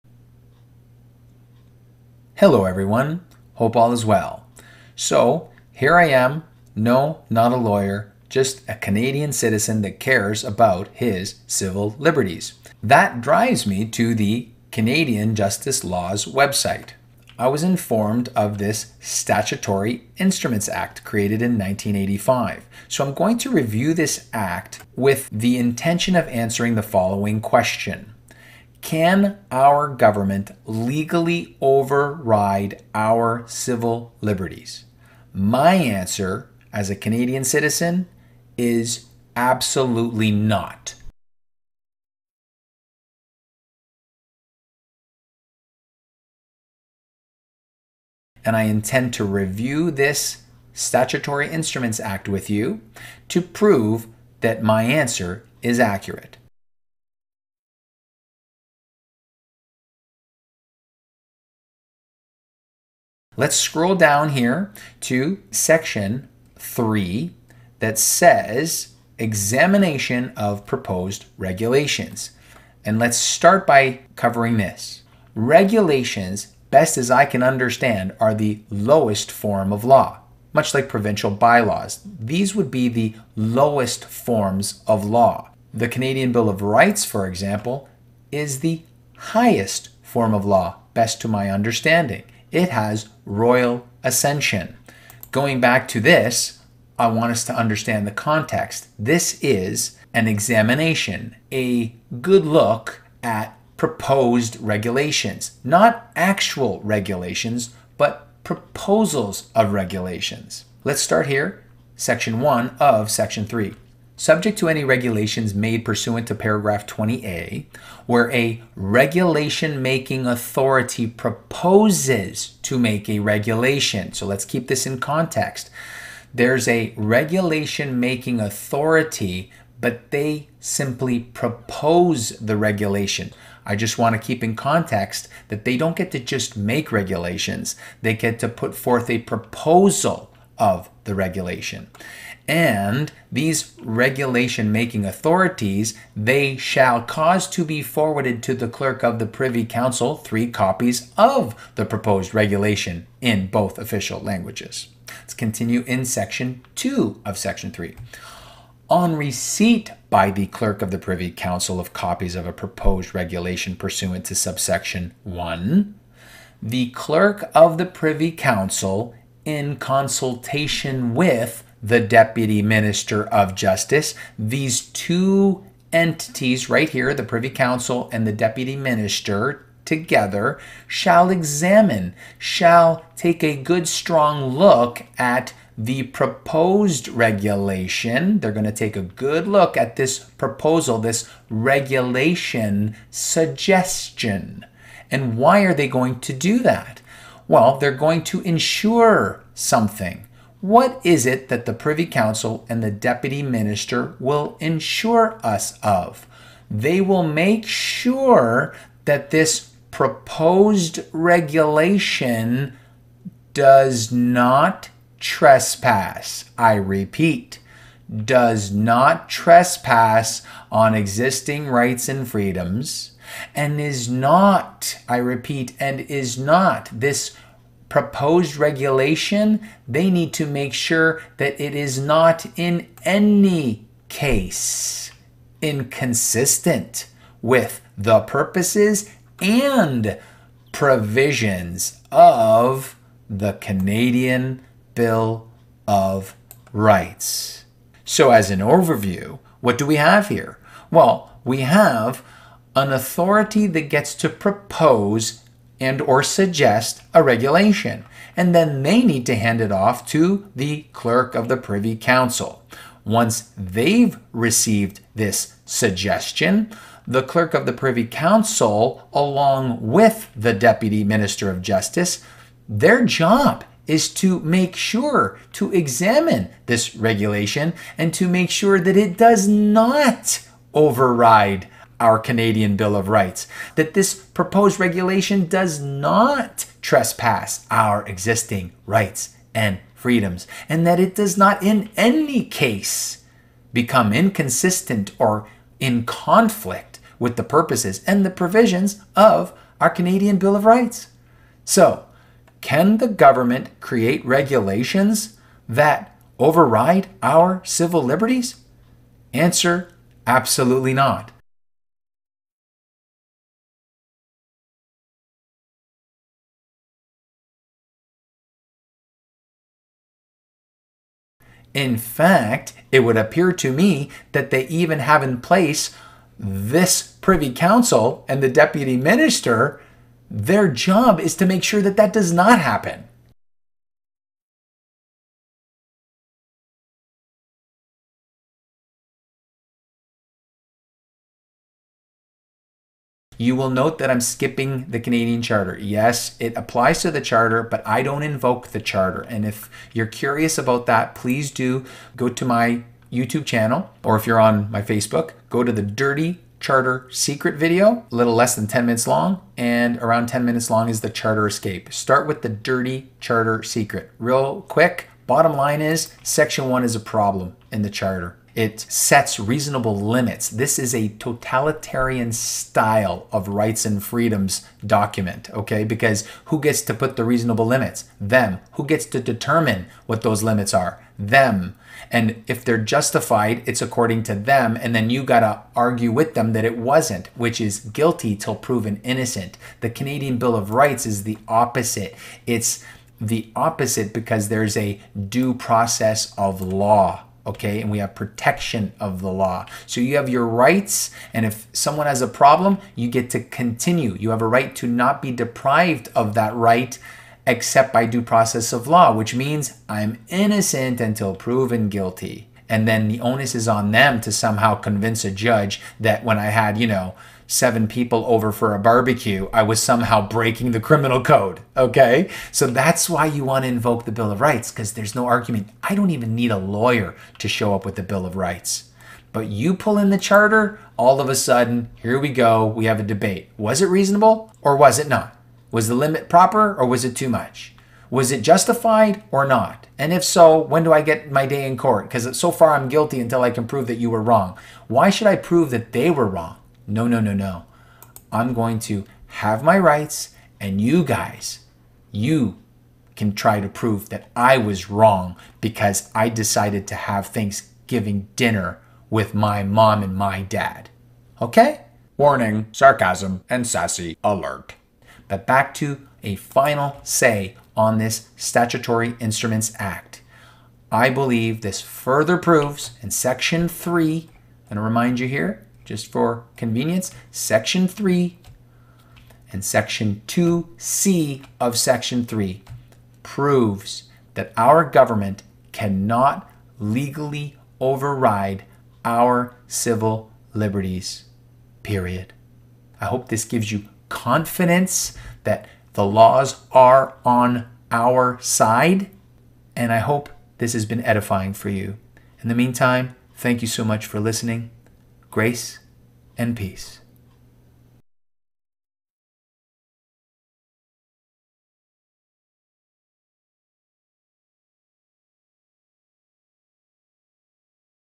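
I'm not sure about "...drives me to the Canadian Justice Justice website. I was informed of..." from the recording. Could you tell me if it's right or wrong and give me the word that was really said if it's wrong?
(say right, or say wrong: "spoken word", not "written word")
wrong: "Laws", not "Justice".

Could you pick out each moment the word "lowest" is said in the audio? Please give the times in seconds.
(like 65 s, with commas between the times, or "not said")
78 s, 83 s.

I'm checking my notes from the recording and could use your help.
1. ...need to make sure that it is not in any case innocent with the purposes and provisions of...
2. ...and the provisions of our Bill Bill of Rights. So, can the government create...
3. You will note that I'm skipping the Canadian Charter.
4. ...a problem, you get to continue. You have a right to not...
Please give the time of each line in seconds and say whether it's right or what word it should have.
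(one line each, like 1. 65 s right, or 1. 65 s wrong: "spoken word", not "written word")
1. 230 s wrong: "inconsistent", not "innocent"
2. 298 s wrong: "Canadian", not "Bill"
3. 343 s right
4. 402 s right.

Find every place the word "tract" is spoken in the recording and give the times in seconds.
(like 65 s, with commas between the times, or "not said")
not said.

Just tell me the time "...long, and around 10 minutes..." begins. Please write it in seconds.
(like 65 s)
359 s.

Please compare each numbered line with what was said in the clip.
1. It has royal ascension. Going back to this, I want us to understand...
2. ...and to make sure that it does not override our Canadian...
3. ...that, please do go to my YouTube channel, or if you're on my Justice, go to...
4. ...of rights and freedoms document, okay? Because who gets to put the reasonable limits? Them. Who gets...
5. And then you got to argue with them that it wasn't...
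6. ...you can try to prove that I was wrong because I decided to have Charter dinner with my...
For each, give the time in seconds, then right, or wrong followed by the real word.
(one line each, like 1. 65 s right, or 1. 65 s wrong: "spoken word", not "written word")
1. 92 s right
2. 277 s right
3. 350 s wrong: "Facebook", not "Justice"
4. 373 s right
5. 384 s right
6. 452 s wrong: "Thanksgiving", not "Charter".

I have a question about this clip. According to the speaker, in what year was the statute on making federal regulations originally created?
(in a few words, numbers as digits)
1985.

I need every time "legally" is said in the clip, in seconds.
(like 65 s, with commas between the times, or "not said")
30 s, 486 s.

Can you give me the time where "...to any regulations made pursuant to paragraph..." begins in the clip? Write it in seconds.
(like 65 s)
114 s.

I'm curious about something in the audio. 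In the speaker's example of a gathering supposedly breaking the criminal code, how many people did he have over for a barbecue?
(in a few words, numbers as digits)
7.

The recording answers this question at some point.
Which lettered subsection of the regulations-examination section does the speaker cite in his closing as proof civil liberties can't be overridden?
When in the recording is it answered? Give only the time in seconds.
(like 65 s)
479 s.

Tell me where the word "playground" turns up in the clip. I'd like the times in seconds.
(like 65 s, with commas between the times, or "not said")
not said.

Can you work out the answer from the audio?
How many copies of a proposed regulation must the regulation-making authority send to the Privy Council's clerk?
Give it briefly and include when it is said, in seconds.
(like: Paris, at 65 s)
3, at 150 s.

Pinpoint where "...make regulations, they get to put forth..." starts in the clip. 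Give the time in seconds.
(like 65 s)
136 s.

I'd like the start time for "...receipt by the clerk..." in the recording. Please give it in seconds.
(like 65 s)
159 s.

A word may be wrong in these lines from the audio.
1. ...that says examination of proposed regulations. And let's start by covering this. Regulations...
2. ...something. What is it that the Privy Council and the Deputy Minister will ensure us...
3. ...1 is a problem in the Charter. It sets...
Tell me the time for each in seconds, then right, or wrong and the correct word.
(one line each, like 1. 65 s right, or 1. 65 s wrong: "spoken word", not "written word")
1. 67 s right
2. 199 s right
3. 366 s right.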